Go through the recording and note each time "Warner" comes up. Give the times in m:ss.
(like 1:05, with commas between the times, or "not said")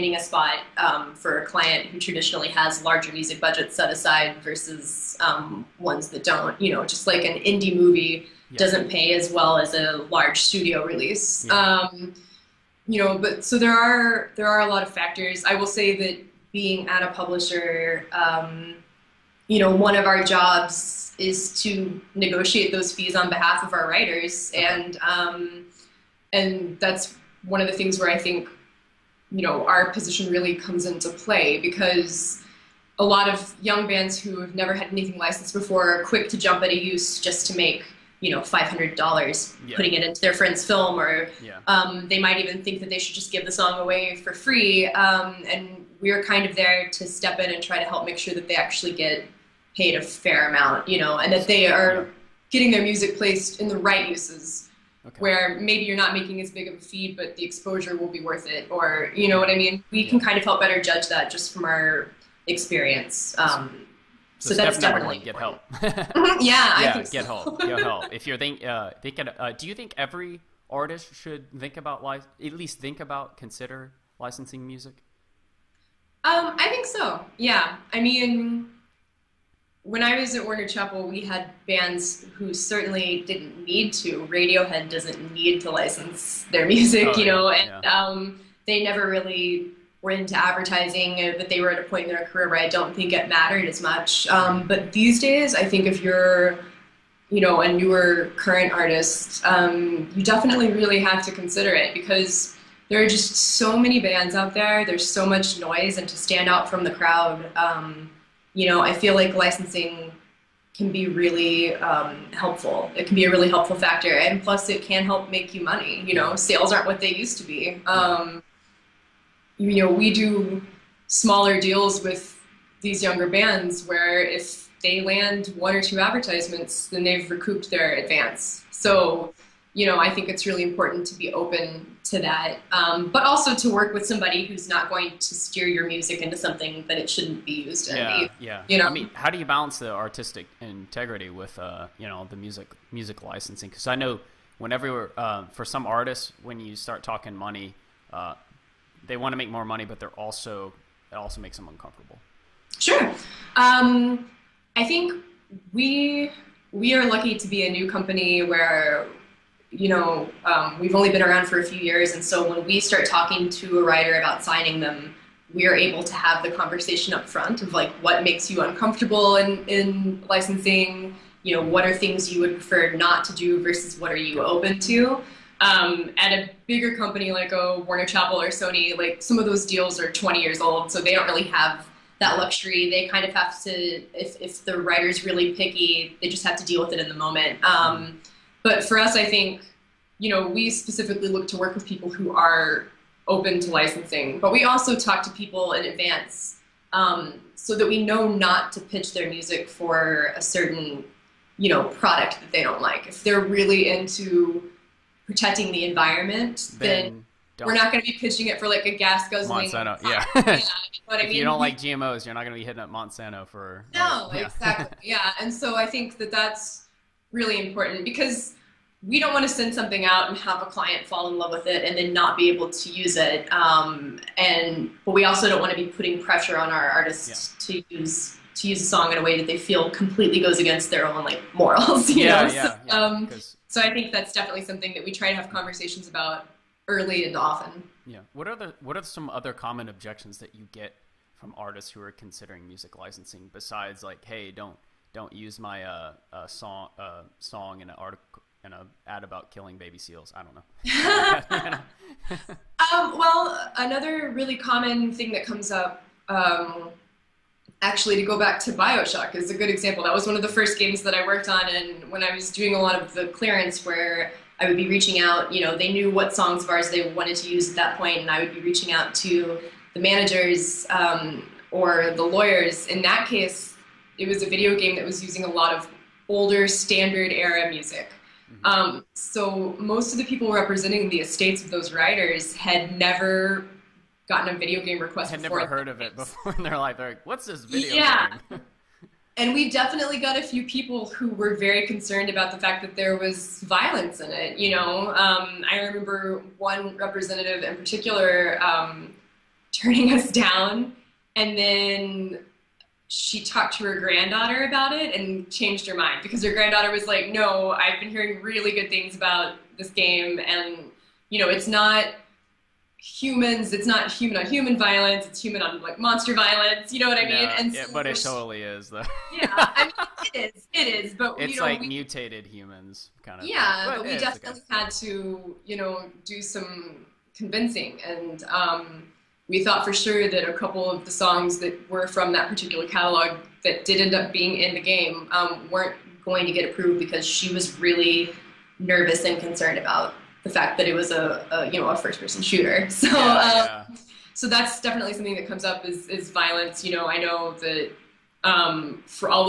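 1:20, 2:57.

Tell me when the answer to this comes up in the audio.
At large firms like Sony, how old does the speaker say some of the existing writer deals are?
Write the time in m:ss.
3:00.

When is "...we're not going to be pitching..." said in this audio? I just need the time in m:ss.
3:27.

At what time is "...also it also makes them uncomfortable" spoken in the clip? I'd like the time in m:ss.
2:30.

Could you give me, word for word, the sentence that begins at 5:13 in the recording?
It's not human on human violence.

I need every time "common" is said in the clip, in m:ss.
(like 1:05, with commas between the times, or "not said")
3:59, 4:14.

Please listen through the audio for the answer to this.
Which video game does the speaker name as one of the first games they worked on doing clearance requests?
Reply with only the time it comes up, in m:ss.
4:18.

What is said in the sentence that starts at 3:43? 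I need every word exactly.
Um, and but we also don't want to be putting pressure on our artists yeah.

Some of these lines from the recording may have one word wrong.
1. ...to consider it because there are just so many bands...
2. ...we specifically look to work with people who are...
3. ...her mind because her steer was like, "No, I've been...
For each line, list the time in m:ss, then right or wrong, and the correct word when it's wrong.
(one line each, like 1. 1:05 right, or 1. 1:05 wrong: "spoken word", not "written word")
1. 1:41 right
2. 3:10 right
3. 5:05 wrong: "granddaughter", not "steer".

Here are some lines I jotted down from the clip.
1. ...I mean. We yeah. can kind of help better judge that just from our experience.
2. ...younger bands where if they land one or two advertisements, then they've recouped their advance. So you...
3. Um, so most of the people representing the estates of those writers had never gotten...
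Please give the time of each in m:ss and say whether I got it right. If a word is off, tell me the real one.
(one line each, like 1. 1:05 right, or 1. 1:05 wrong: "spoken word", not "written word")
1. 0:59 right
2. 2:03 right
3. 4:38 right.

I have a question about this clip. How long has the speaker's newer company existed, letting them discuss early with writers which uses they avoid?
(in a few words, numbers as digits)
A few years.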